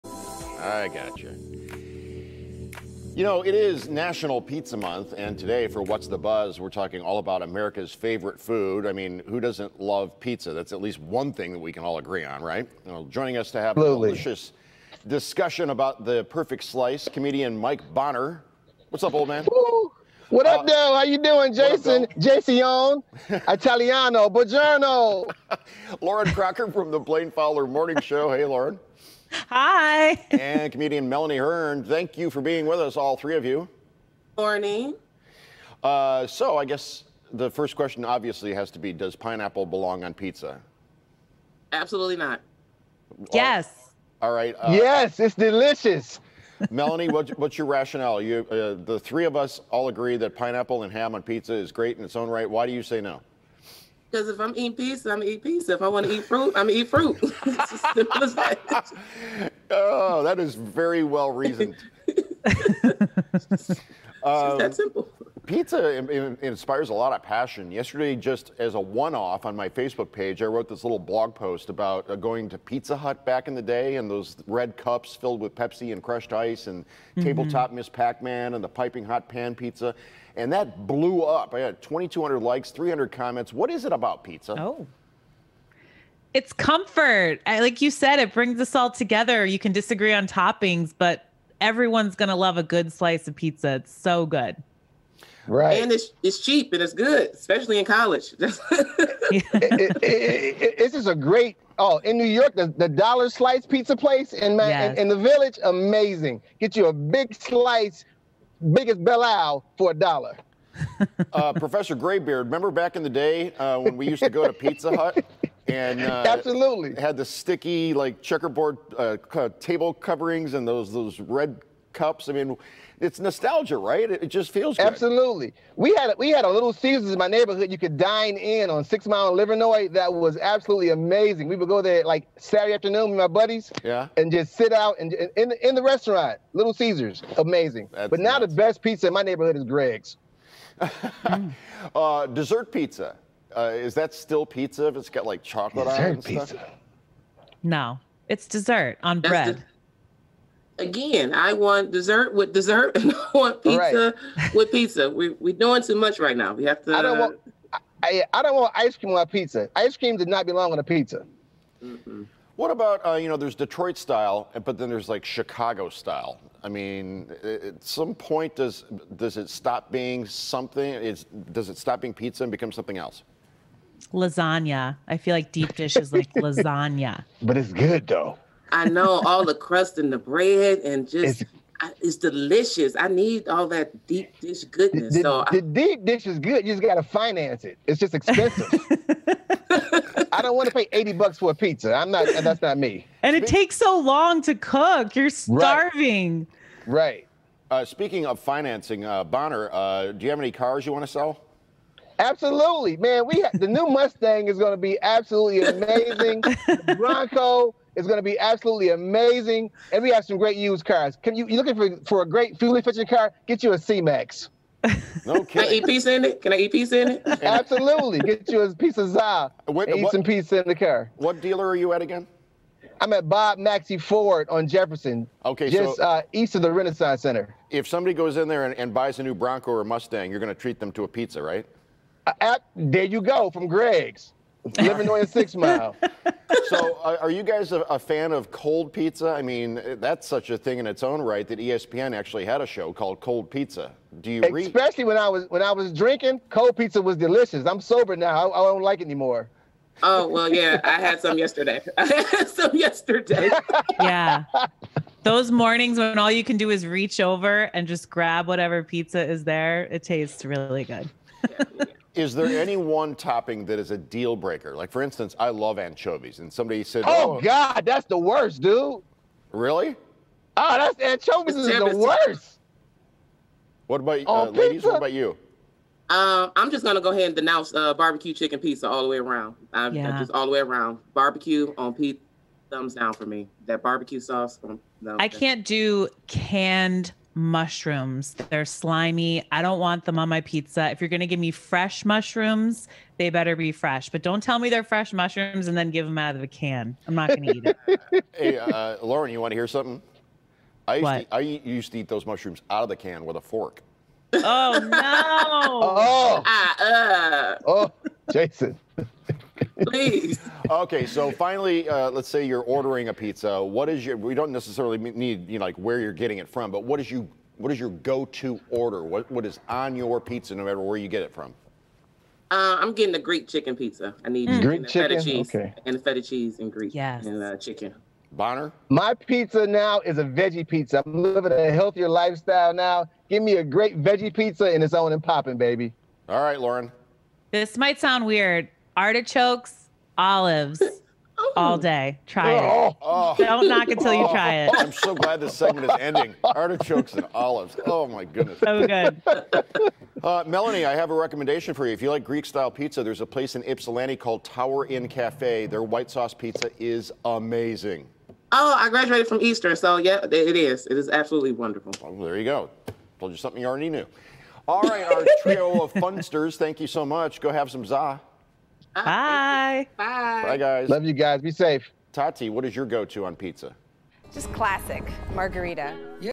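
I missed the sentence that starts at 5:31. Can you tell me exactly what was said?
I'm living a healthier lifestyle now.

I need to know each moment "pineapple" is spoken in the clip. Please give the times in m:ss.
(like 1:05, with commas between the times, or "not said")
0:39, 0:50.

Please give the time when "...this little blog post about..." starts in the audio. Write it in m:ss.
1:10.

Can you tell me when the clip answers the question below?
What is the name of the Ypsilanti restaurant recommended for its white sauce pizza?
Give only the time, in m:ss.
5:54.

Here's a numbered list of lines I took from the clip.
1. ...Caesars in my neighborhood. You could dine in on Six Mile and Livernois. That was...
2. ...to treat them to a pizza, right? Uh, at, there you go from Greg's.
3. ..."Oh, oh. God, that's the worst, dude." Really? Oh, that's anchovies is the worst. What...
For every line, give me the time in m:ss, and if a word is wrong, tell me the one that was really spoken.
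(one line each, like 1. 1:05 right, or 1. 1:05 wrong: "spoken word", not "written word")
1. 2:06 right
2. 3:50 right
3. 4:27 right.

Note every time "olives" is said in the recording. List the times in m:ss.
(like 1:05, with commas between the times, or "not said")
5:40, 5:47.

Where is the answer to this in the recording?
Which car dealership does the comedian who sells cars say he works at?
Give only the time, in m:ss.
3:43.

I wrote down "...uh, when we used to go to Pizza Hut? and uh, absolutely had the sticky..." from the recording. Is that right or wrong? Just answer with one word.
right.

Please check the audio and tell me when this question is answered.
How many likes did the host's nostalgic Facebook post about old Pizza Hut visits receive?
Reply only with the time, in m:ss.
1:21.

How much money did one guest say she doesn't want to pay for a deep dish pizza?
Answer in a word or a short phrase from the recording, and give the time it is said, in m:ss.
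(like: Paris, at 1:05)
80 bucks, at 3:10.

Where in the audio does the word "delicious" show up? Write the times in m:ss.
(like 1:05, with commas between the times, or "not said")
0:14, 0:45, 3:02, 4:07.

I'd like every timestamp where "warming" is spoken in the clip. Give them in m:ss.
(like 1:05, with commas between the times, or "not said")
not said.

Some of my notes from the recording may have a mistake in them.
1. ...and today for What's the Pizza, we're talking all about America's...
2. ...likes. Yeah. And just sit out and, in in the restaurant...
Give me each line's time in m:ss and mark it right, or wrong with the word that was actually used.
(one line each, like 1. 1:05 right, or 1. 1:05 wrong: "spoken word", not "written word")
1. 0:05 wrong: "Buzz", not "Pizza"
2. 2:13 wrong: "buddies", not "likes".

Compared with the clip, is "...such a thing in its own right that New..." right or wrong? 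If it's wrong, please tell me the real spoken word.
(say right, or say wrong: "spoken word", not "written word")
wrong: "ESPN", not "New".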